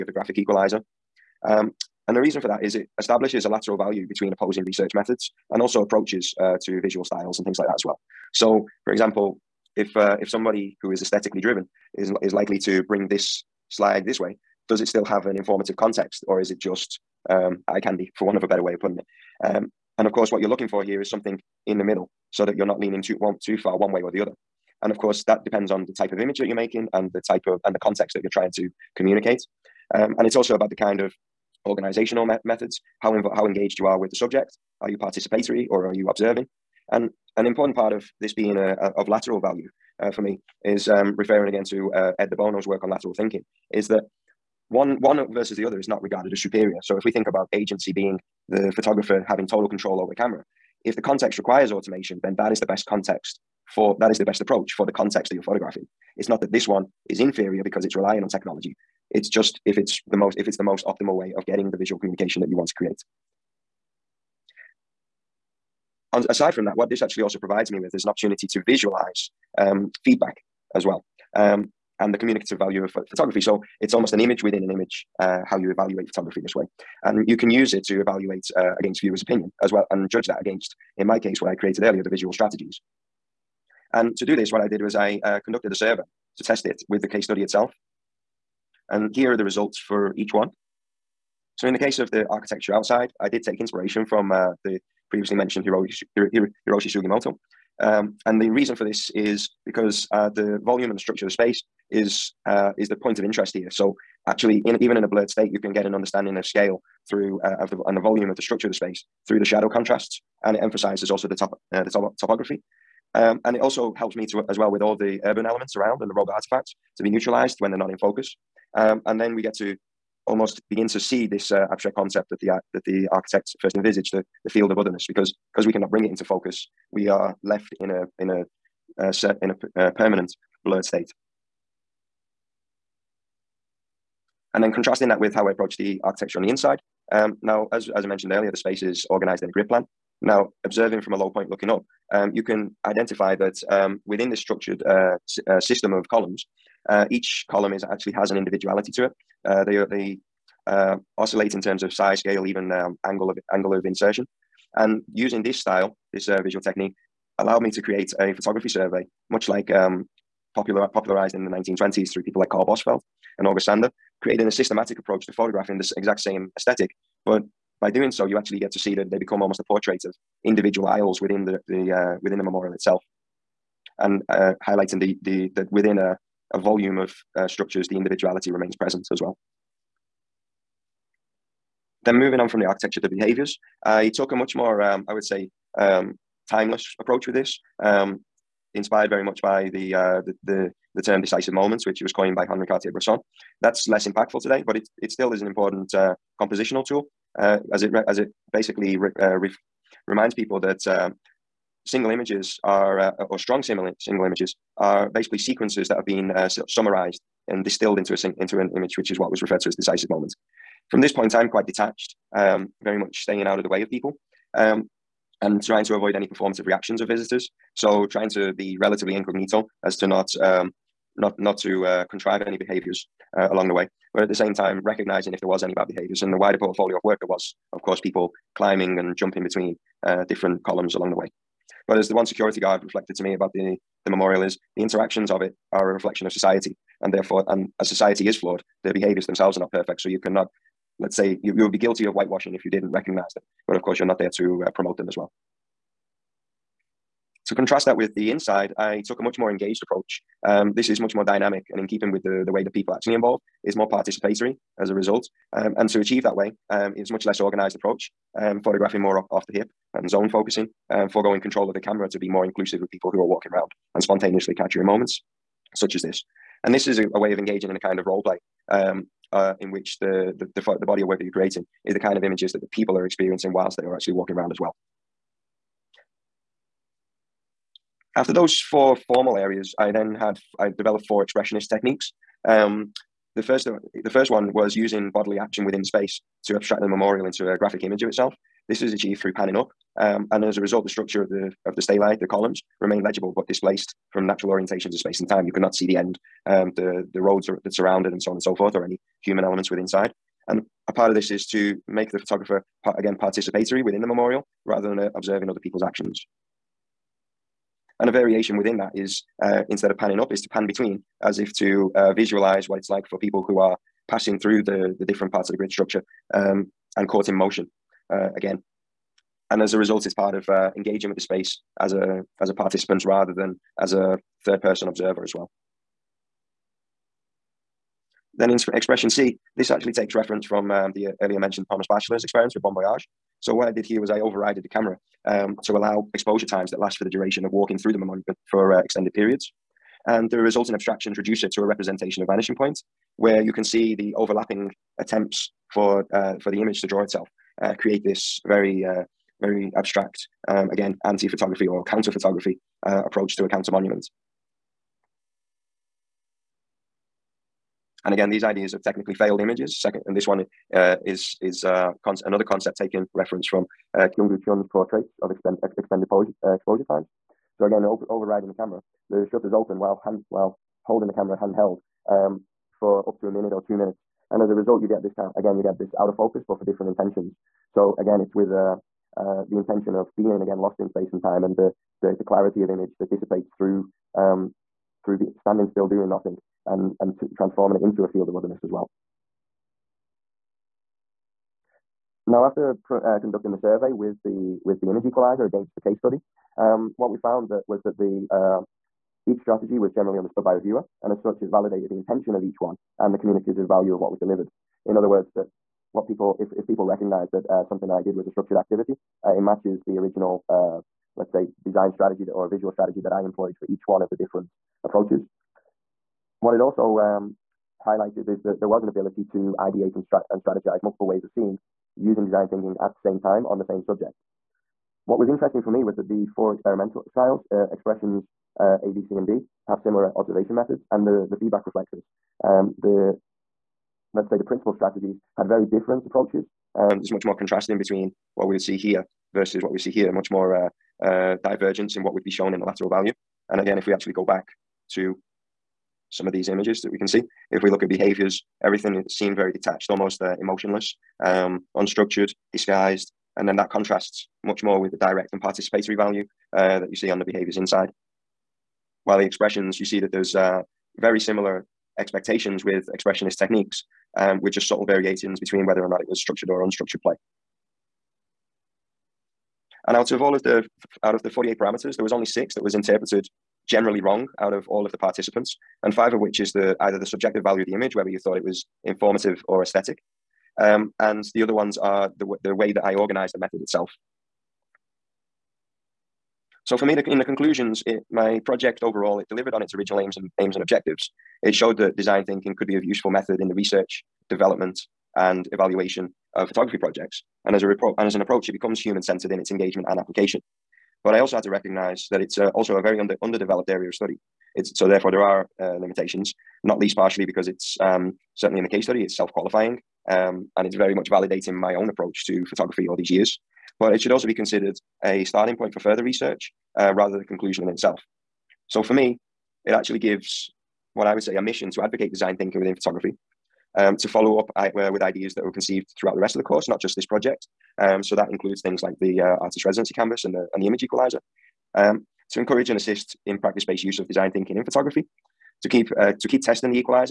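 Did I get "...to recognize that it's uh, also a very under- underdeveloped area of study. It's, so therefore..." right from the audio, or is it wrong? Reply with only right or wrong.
right.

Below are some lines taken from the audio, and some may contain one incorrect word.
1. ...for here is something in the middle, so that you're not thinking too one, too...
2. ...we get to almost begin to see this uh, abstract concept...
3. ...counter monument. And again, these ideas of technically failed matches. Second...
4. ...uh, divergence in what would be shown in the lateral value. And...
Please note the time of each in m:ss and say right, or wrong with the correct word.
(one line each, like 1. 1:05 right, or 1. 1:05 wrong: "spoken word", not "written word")
1. 0:20 wrong: "leaning", not "thinking"
2. 1:59 right
3. 5:53 wrong: "images", not "matches"
4. 7:21 right.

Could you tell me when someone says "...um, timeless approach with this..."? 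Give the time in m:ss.
3:05.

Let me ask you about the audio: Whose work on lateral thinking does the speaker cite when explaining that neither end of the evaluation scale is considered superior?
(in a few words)
Ed De Bono.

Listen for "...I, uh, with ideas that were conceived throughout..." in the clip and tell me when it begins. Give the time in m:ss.
8:44.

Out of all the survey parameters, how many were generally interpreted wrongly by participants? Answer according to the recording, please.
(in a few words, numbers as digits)
6.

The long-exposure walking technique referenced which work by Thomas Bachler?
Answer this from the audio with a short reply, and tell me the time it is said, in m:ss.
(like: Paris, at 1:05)
Bon Voyage, at 5:32.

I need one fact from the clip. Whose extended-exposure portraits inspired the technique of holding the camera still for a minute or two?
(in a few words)
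Kyungwoo Chun.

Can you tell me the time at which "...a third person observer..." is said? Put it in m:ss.
5:23.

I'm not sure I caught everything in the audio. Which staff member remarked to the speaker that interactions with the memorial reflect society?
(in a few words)
security guard.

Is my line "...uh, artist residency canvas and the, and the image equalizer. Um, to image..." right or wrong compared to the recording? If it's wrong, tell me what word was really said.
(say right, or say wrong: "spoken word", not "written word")
wrong: "encourage", not "image".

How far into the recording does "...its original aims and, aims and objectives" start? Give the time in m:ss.
8:09.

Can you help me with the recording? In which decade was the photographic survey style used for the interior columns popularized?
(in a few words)
1920s.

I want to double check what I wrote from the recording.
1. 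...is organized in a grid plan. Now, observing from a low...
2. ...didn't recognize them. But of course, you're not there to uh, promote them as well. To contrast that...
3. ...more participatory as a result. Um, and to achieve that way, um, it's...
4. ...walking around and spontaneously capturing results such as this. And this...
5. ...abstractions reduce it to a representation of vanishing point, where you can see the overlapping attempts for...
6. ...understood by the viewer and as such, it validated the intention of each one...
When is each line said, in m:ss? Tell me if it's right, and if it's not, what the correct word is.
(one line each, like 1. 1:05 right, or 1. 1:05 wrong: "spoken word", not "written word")
1. 2:18 right
2. 4:02 right
3. 4:13 right
4. 4:23 wrong: "moments", not "results"
5. 5:40 right
6. 6:40 right.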